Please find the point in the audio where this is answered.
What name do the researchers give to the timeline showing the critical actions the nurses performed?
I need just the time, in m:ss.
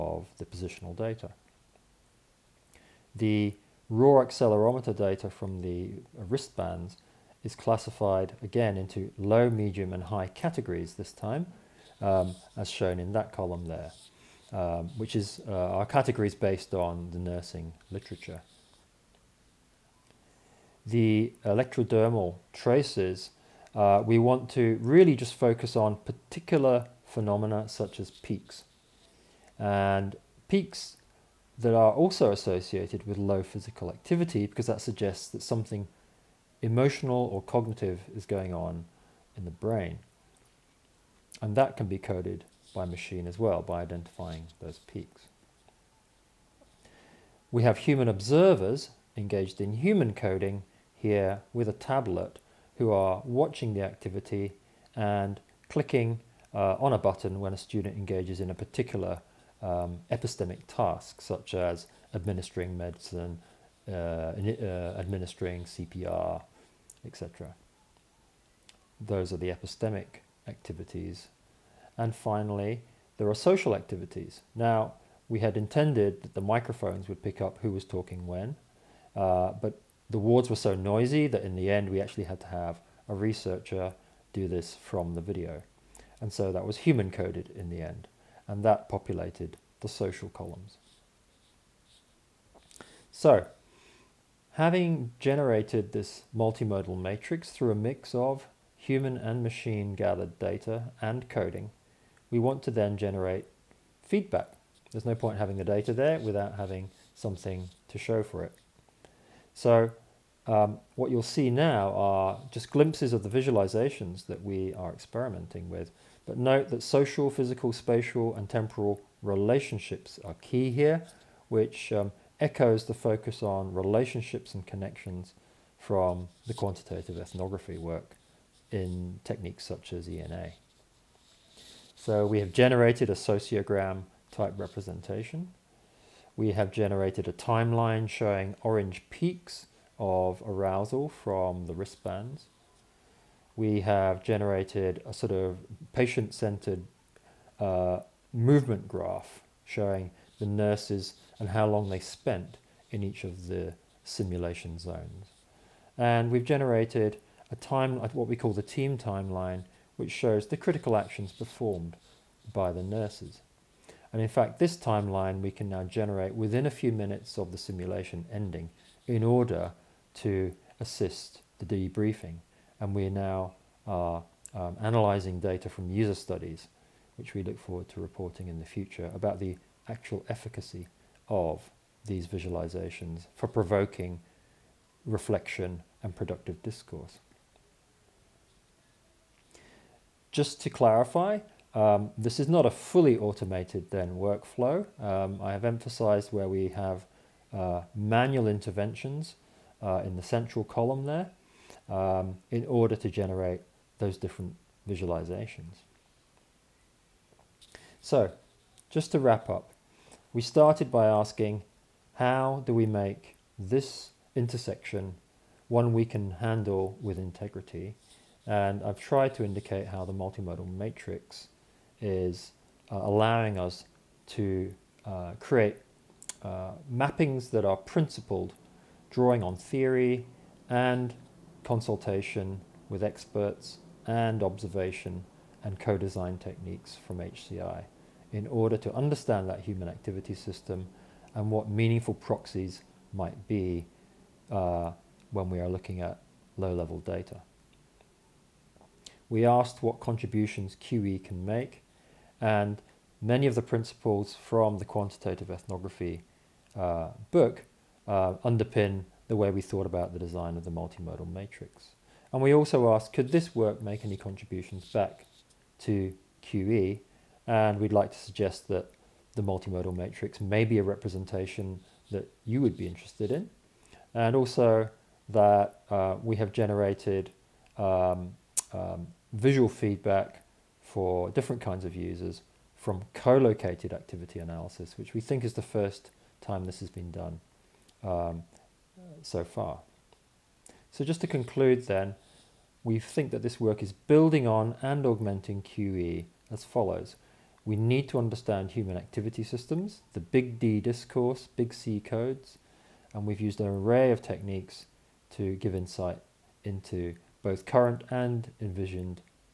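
2:38.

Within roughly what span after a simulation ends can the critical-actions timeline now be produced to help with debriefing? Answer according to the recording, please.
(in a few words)
a few minutes.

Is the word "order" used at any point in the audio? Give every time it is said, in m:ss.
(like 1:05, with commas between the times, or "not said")
2:49, 3:22, 3:58.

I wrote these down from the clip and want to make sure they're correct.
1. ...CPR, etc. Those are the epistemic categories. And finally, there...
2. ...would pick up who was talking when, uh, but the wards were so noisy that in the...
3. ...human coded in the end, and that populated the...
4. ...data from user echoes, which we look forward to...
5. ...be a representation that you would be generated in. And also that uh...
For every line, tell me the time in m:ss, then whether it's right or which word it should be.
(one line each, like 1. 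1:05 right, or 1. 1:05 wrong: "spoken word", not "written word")
1. 1:05 wrong: "activities", not "categories"
2. 1:17 right
3. 1:26 right
4. 2:55 wrong: "studies", not "echoes"
5. 4:30 wrong: "interested", not "generated".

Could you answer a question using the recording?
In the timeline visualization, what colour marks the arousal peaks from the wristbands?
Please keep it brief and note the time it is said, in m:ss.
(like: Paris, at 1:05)
orange, at 2:18.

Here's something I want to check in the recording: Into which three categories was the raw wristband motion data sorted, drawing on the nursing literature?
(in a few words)
low, medium, and high.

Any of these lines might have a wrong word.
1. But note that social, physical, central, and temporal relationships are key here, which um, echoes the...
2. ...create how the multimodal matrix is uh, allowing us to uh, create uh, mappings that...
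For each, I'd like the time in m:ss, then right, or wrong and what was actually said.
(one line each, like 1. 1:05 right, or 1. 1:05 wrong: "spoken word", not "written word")
1. 1:56 wrong: "spatial", not "central"
2. 3:39 wrong: "indicate", not "create".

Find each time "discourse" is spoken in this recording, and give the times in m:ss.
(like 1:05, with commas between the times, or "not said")
3:06, 5:00.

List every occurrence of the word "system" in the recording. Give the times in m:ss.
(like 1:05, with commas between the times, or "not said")
4:00, 4:59.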